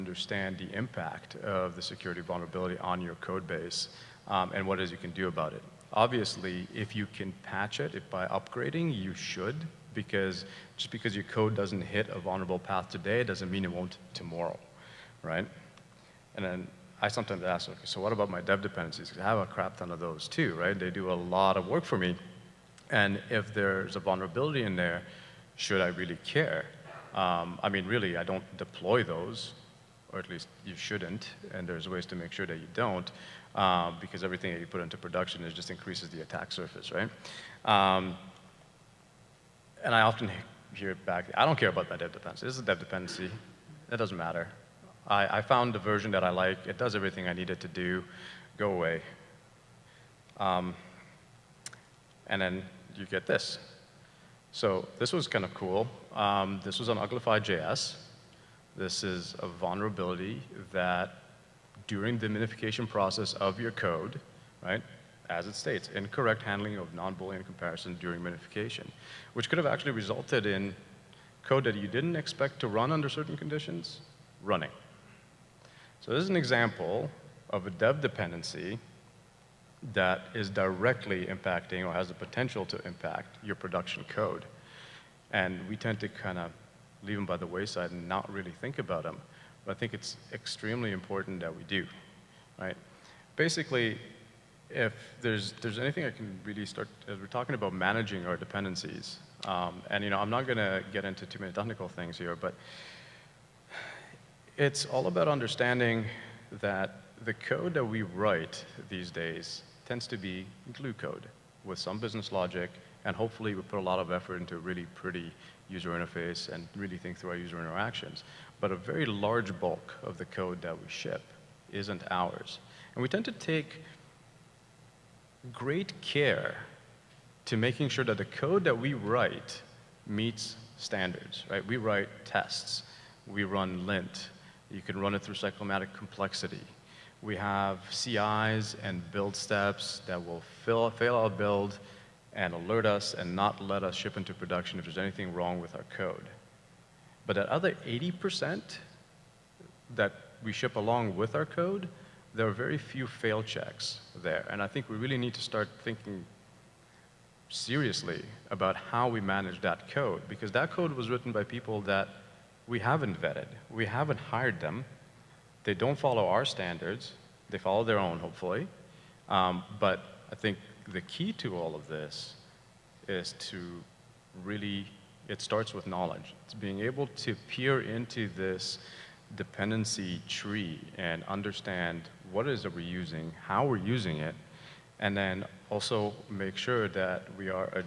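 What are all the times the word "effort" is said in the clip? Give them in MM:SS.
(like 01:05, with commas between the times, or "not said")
01:54.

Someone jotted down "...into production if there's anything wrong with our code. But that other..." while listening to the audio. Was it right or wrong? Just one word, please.
right.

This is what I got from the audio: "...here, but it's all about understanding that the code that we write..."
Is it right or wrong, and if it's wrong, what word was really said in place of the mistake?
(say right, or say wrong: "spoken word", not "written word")
right.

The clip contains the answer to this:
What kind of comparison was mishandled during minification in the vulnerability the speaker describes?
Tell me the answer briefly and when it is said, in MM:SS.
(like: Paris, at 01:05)
Non-Boolean comparison, at 01:06.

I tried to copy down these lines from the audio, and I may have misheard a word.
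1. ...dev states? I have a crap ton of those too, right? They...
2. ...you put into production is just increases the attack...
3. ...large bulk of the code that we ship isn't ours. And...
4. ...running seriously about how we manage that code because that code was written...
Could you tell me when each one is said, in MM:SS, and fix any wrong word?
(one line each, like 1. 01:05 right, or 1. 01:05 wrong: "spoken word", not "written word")
1. 00:18 wrong: "dependencies", not "states"
2. 00:34 right
3. 01:59 right
4. 02:35 wrong: "thinking", not "running".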